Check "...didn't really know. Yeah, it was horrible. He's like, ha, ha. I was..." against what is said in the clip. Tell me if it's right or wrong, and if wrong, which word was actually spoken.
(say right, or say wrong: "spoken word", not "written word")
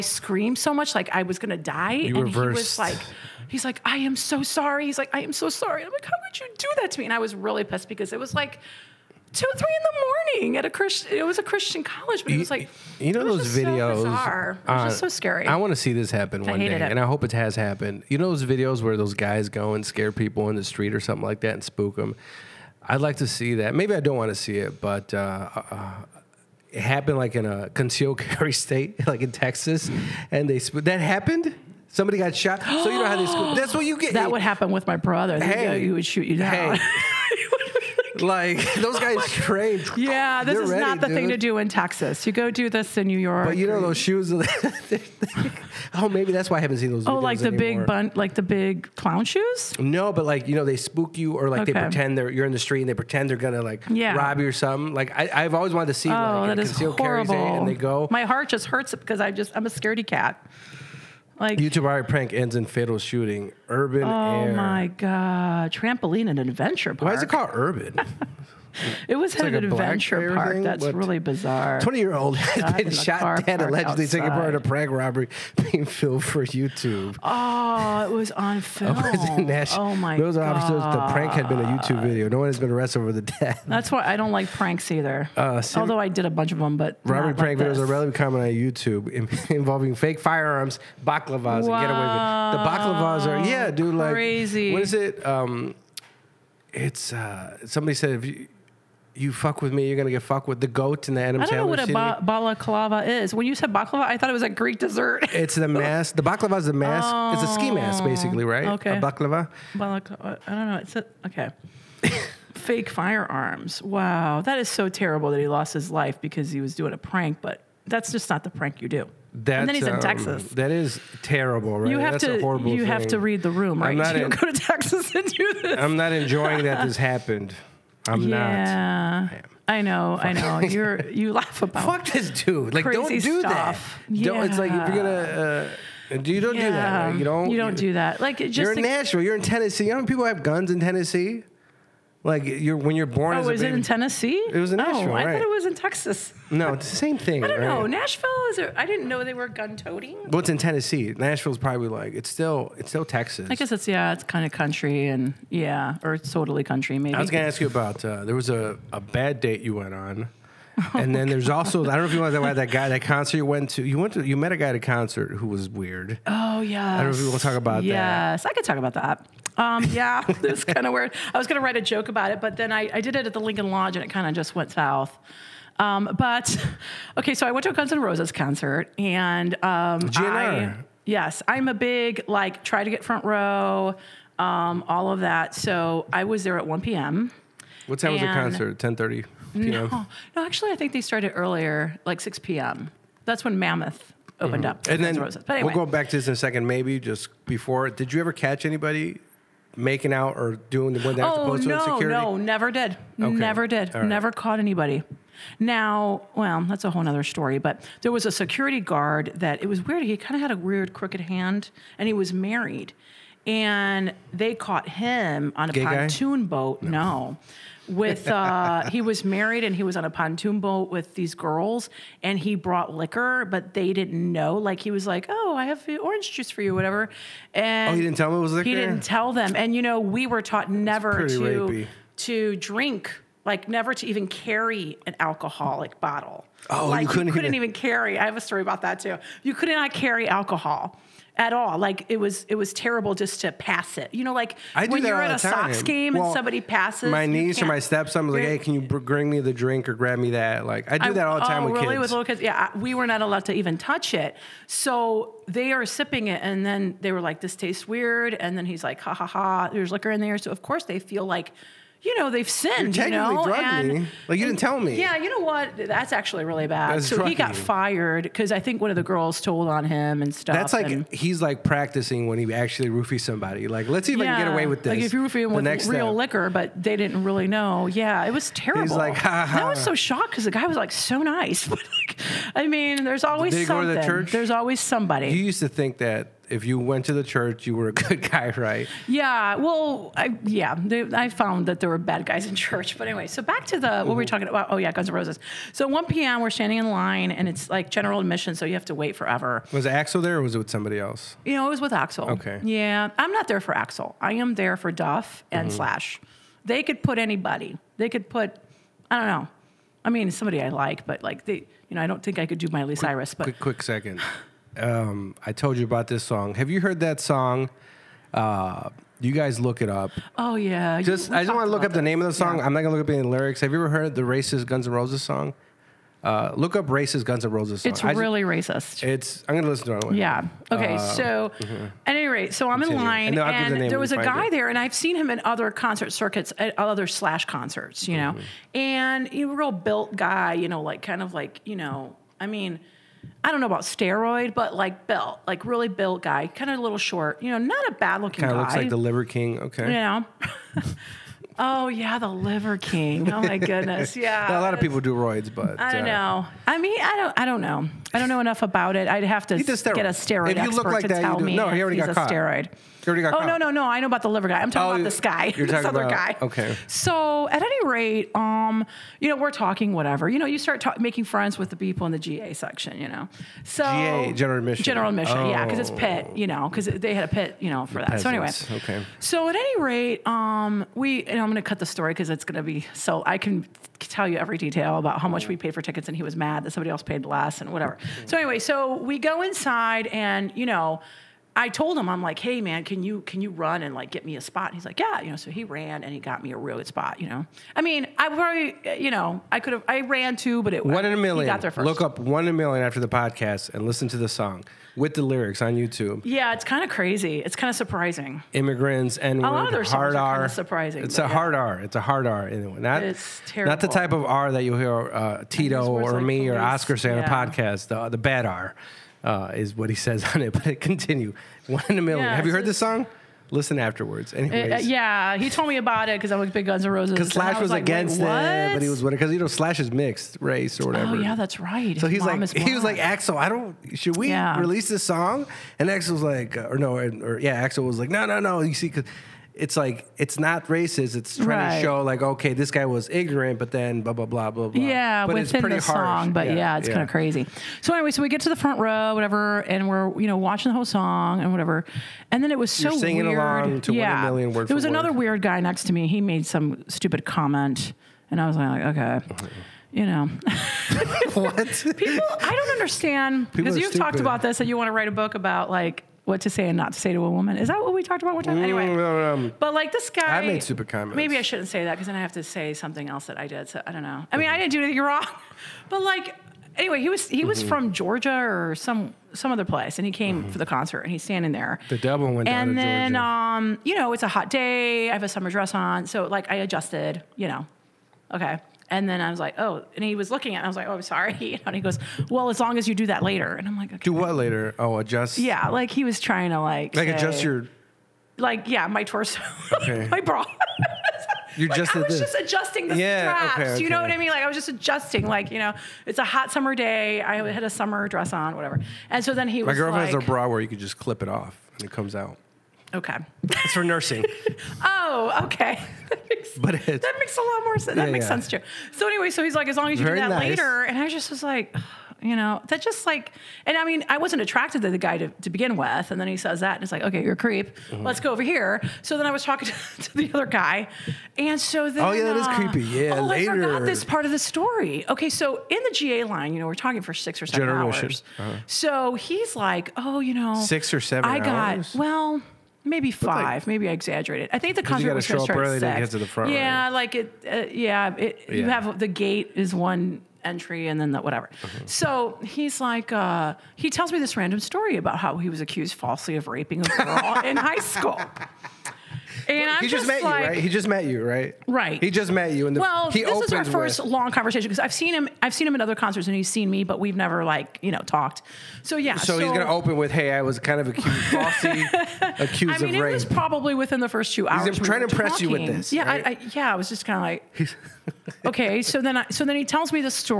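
wrong: "terrible", not "horrible".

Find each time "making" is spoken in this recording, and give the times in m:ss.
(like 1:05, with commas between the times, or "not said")
3:19, 6:10.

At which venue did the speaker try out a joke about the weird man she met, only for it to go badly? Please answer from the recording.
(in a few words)
The Lincoln Lodge.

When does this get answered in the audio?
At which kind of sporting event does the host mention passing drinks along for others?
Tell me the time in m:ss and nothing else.
4:05.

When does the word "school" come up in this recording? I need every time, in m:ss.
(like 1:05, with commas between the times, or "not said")
0:33, 9:17.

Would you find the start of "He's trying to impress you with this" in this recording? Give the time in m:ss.
9:34.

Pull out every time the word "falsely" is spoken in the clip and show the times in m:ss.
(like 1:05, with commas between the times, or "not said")
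9:15, 9:31.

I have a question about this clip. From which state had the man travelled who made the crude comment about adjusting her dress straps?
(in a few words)
Georgia.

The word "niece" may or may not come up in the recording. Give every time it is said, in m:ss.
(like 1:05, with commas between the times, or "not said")
4:07.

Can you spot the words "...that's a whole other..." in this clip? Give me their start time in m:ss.
3:26.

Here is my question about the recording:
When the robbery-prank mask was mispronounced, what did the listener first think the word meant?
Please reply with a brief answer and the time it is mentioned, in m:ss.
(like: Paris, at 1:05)
A Greek dessert, at 1:44.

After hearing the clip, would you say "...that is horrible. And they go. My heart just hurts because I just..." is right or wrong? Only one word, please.
right.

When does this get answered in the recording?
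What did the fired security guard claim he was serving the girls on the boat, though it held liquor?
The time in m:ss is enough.
3:46.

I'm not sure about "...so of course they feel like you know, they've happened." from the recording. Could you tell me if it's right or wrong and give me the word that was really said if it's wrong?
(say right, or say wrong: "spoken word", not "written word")
wrong: "sinned", not "happened".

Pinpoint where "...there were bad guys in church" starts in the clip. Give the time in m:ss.
4:51.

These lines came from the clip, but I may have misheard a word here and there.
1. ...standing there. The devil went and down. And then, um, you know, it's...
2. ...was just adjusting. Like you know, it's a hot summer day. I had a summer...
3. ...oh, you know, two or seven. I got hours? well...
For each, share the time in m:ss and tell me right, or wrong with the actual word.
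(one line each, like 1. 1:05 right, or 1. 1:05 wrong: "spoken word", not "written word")
1. 8:01 right
2. 8:24 right
3. 8:59 wrong: "six", not "two".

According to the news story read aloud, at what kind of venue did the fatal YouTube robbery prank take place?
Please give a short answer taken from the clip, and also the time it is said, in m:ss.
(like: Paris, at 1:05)
Trampoline and adventure park, at 1:05.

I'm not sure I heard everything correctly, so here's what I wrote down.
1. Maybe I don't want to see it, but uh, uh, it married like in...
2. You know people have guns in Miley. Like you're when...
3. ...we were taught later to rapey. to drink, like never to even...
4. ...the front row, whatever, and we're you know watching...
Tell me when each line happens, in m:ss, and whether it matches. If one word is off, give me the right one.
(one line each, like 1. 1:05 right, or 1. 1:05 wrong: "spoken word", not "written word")
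1. 0:23 wrong: "happened", not "married"
2. 2:19 wrong: "Tennessee", not "Miley"
3. 3:50 wrong: "never", not "later"
4. 7:28 right.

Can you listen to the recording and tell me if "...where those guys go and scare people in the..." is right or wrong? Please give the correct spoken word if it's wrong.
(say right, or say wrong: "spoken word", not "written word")
right.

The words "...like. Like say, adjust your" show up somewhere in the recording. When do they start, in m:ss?
8:16.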